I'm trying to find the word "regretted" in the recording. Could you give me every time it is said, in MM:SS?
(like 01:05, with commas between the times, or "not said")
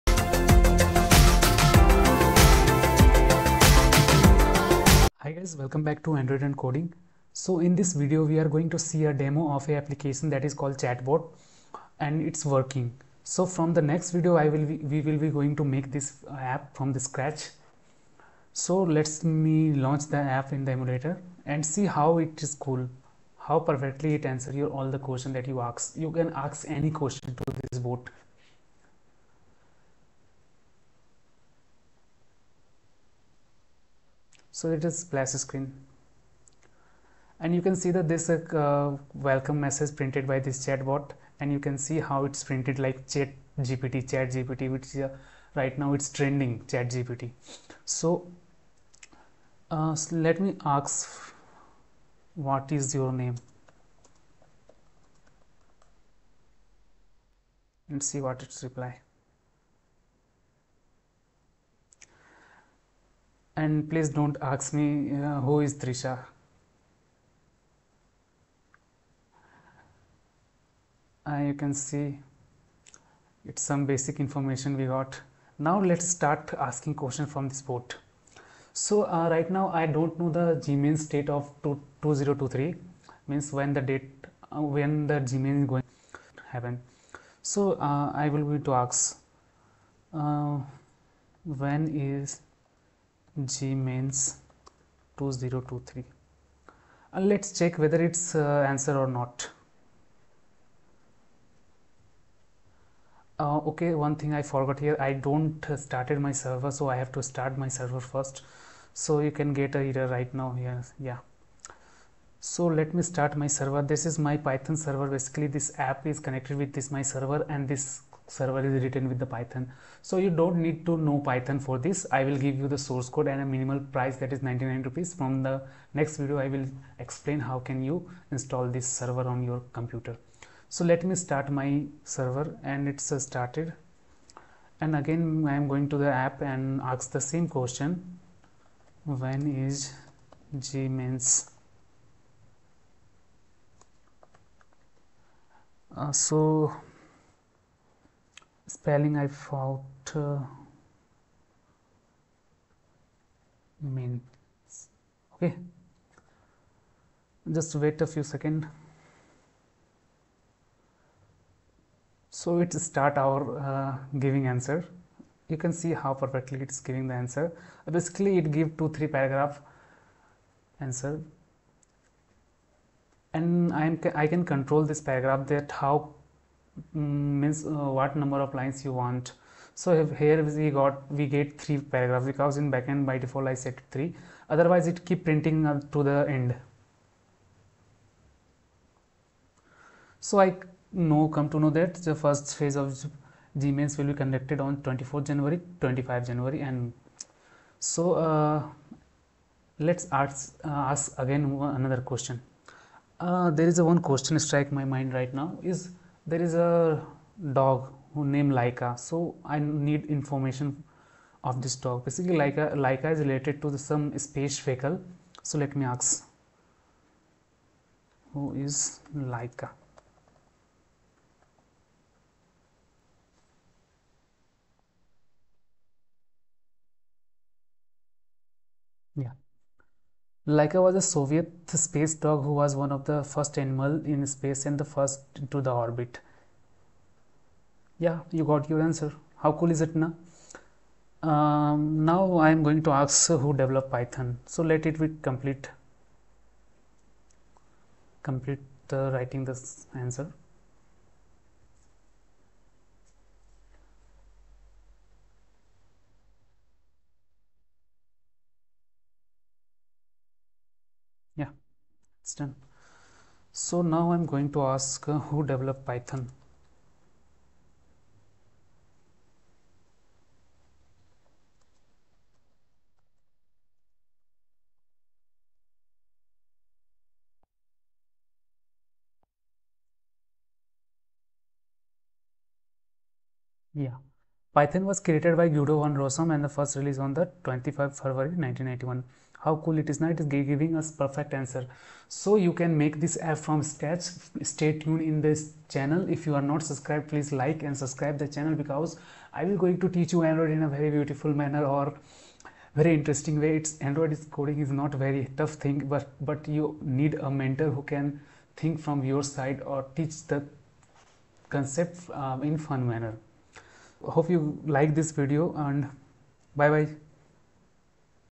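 not said.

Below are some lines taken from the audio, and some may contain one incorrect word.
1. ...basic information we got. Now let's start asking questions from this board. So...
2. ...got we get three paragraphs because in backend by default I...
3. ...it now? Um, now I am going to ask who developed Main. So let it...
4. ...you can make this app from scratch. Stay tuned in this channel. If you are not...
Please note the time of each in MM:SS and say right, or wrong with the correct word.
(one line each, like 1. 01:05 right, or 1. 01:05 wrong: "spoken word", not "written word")
1. 01:13 right
2. 03:00 right
3. 03:59 wrong: "Python", not "Main"
4. 04:52 right.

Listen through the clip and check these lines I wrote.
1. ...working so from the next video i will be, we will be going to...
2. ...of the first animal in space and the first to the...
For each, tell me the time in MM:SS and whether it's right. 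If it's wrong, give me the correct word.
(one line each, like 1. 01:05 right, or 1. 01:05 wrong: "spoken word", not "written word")
1. 00:12 right
2. 03:52 right.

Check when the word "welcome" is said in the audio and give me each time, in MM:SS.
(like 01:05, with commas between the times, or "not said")
00:05, 00:39.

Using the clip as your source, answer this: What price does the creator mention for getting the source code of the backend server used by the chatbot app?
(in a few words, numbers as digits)
99 rupees.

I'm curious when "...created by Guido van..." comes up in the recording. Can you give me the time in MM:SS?
04:44.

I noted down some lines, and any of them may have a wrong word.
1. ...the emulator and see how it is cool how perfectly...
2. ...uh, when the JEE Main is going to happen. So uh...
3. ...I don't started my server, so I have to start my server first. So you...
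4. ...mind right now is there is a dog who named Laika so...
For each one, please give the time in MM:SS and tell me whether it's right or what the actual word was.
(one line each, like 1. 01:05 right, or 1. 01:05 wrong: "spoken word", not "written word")
1. 00:20 right
2. 01:24 right
3. 01:44 right
4. 03:24 right.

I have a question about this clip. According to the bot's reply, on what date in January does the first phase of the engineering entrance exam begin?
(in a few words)
24th January.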